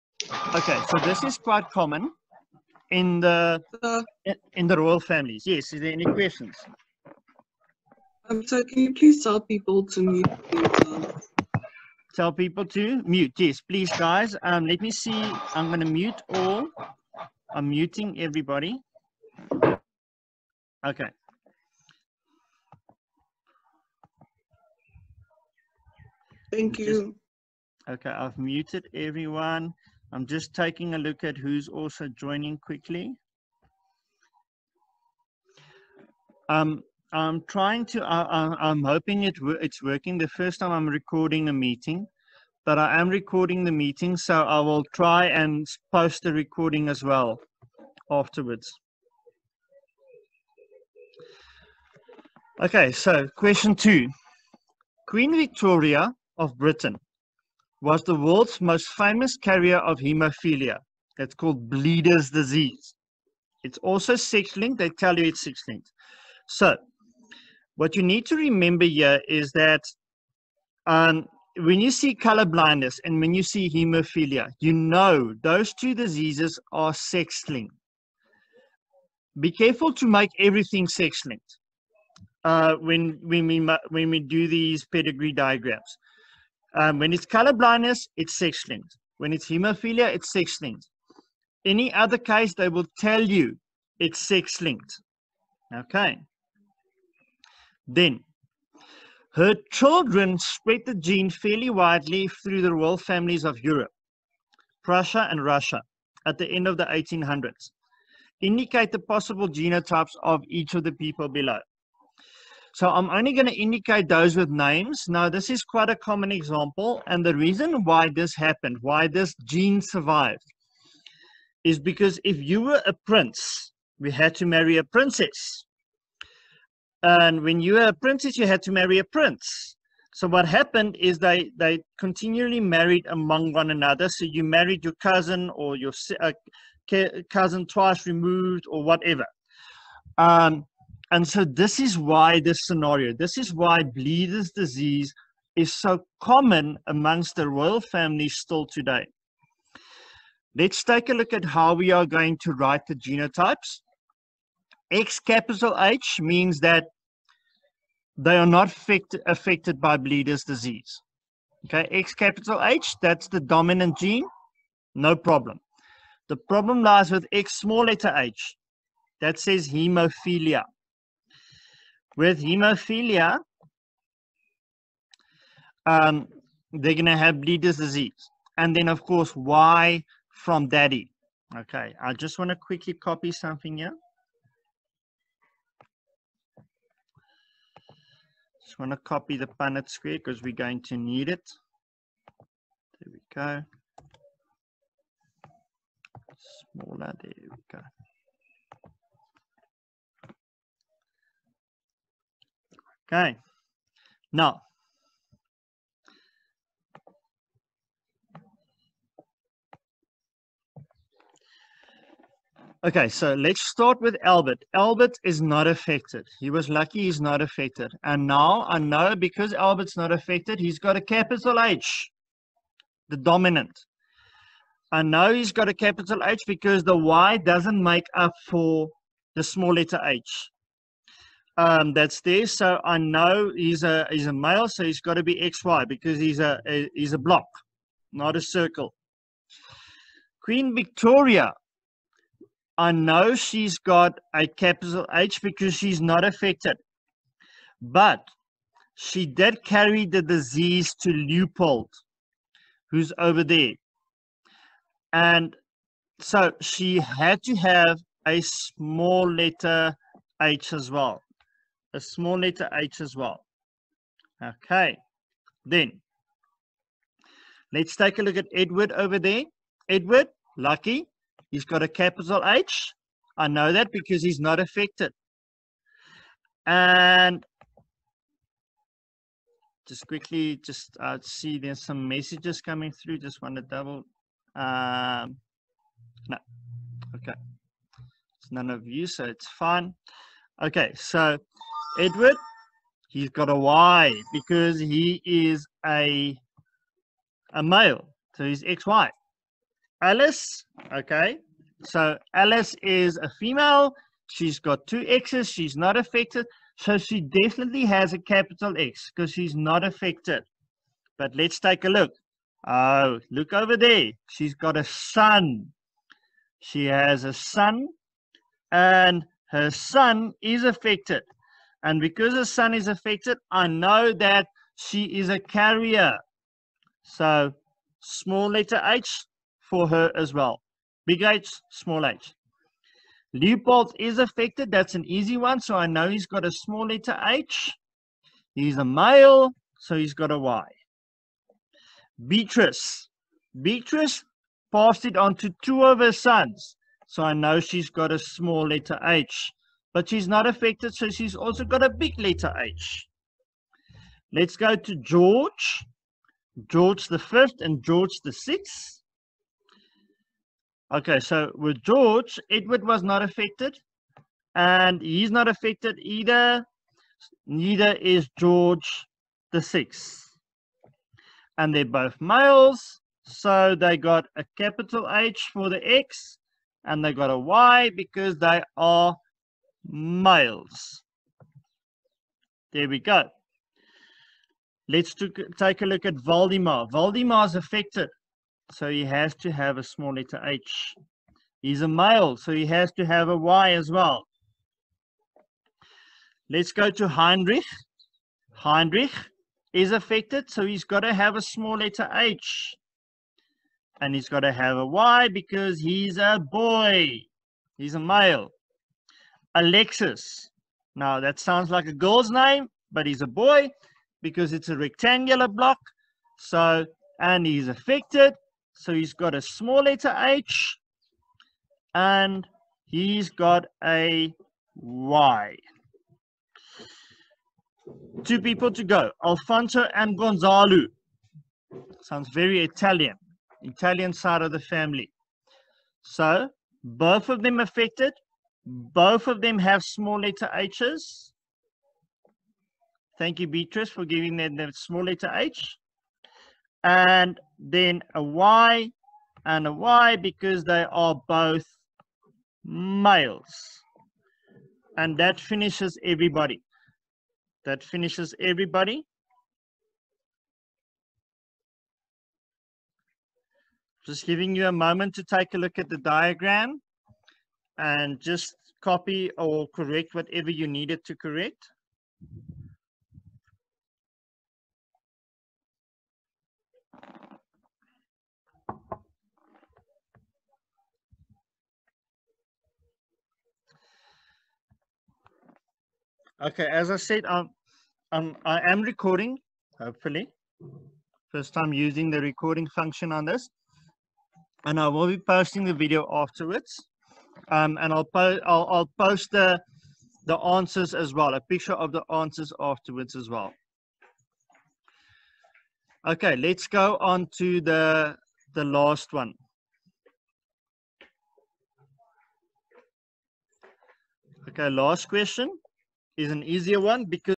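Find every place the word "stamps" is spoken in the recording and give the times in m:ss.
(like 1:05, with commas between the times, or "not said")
not said.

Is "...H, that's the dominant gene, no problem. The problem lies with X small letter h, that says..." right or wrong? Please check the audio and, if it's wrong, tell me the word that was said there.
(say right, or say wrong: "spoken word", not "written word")
right.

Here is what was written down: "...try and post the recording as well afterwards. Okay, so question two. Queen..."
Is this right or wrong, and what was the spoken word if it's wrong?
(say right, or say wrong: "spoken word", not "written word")
right.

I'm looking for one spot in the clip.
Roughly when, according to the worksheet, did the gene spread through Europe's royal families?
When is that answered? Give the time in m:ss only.
1:46.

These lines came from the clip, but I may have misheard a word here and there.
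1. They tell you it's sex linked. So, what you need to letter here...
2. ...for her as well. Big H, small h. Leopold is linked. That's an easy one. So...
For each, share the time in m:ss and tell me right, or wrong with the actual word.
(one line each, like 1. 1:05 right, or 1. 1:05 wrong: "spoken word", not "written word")
1. 1:04 wrong: "remember", not "letter"
2. 5:29 wrong: "affected", not "linked".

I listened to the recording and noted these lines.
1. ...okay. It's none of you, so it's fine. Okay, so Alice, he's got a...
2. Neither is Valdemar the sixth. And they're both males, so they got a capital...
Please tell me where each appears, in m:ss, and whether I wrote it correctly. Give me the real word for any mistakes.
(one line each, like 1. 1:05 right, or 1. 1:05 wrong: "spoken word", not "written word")
1. 4:47 wrong: "Edward", not "Alice"
2. 6:07 wrong: "George", not "Valdemar".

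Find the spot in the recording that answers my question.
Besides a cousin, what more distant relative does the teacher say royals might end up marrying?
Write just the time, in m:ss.
2:17.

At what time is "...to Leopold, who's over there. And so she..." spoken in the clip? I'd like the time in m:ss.
4:11.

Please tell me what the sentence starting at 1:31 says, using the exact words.
Any other case, they will tell you it's sex linked.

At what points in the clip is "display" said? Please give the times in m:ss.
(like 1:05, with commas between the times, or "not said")
not said.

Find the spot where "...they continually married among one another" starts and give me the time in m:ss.
2:11.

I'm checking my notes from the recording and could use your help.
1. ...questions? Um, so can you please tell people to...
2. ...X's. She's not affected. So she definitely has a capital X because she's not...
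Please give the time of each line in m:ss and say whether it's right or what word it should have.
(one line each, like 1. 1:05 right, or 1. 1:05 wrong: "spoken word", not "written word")
1. 0:06 right
2. 5:05 right.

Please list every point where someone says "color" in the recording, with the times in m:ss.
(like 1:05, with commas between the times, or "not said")
1:12, 1:27.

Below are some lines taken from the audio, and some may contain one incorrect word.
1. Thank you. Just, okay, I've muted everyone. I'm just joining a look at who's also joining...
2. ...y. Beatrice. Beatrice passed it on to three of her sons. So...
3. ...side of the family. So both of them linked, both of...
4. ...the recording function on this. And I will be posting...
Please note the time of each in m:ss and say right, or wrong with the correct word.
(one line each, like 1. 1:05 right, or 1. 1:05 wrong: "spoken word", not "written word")
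1. 0:26 wrong: "taking", not "joining"
2. 5:40 wrong: "two", not "three"
3. 7:14 wrong: "affected", not "linked"
4. 8:12 right.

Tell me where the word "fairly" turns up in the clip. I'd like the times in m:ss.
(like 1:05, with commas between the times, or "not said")
1:41.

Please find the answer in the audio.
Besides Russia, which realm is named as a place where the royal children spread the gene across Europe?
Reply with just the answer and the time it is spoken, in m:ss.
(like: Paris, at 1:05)
Prussia, at 1:44.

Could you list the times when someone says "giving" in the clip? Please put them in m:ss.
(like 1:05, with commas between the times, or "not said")
7:24, 7:44.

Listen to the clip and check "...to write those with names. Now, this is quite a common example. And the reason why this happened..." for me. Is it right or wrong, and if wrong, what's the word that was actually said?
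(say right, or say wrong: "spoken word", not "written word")
wrong: "indicate", not "write".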